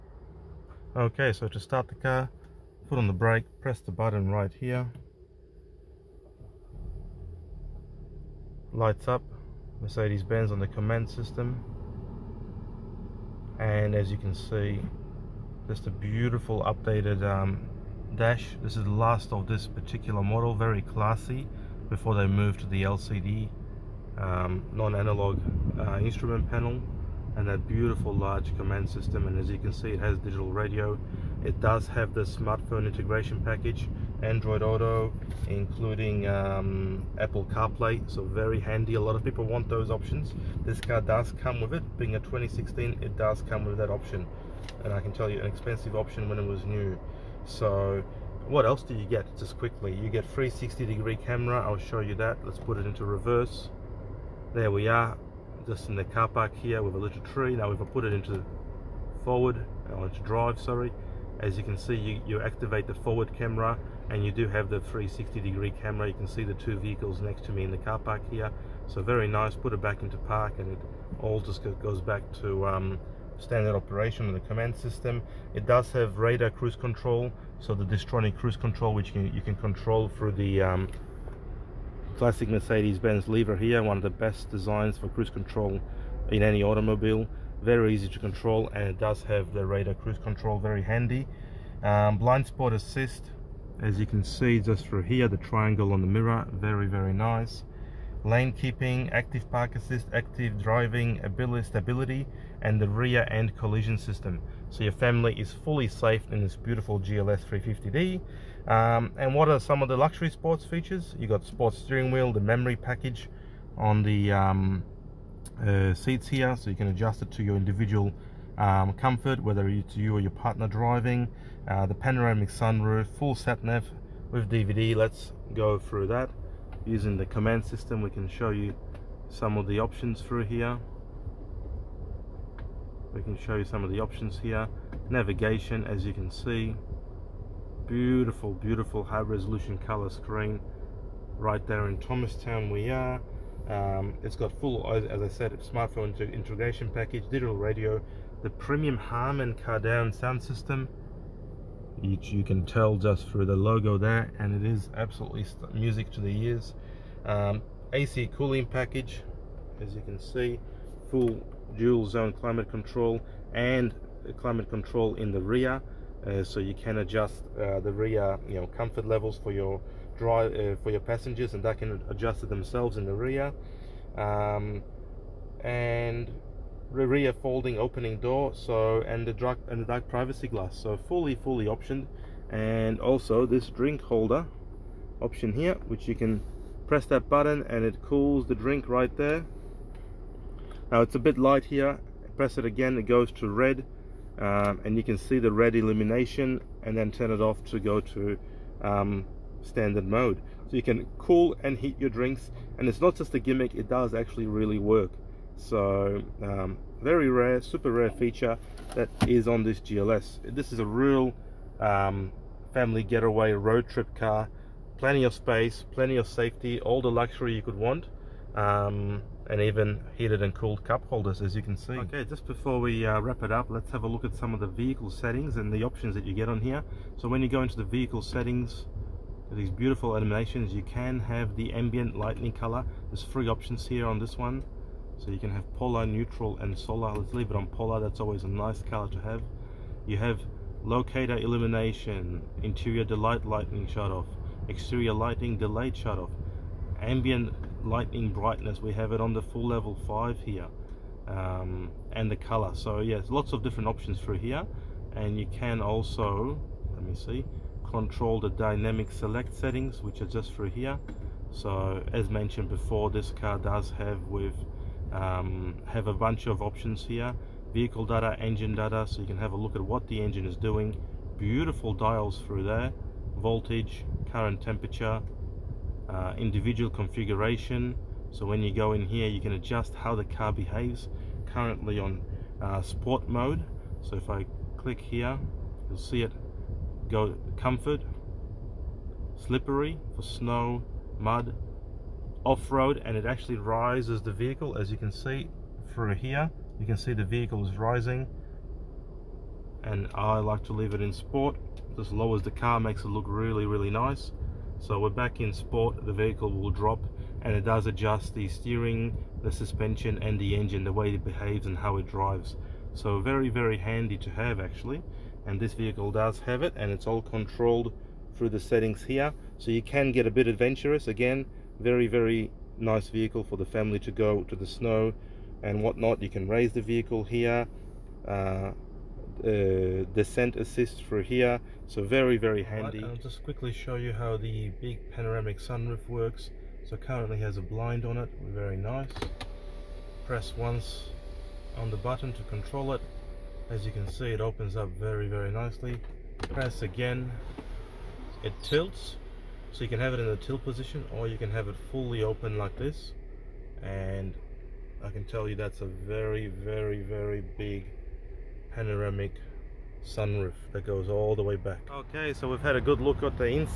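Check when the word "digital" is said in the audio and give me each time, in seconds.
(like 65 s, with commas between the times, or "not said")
30 s, 147 s.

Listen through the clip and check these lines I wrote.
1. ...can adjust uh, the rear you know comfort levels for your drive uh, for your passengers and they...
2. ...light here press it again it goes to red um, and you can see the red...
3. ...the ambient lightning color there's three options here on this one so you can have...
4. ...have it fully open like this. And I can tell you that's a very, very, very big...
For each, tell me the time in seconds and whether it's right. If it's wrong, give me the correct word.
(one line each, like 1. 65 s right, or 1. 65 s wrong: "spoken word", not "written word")
1. 166 s right
2. 191 s right
3. 231 s right
4. 351 s right.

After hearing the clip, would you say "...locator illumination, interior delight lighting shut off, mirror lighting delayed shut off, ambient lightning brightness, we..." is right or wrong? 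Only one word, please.
wrong.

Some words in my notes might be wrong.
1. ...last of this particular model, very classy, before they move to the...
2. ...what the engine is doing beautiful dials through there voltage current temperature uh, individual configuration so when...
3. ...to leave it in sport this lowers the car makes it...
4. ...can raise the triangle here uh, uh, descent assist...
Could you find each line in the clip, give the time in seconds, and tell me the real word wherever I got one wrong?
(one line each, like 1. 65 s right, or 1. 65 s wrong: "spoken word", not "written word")
1. 18 s right
2. 269 s right
3. 300 s right
4. 326 s wrong: "vehicle", not "triangle".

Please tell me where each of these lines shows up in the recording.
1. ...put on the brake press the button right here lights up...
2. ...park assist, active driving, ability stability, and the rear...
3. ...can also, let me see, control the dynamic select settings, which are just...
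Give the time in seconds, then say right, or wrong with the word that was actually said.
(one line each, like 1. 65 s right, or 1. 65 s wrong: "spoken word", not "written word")
1. 2 s right
2. 99 s right
3. 255 s right.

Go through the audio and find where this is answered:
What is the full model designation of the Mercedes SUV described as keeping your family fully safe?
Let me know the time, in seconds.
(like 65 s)
106 s.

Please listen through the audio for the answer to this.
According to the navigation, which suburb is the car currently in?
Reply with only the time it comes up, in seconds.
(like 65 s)
141 s.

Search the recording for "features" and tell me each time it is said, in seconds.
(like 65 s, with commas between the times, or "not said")
110 s, 208 s.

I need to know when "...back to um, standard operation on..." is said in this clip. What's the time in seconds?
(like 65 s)
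72 s.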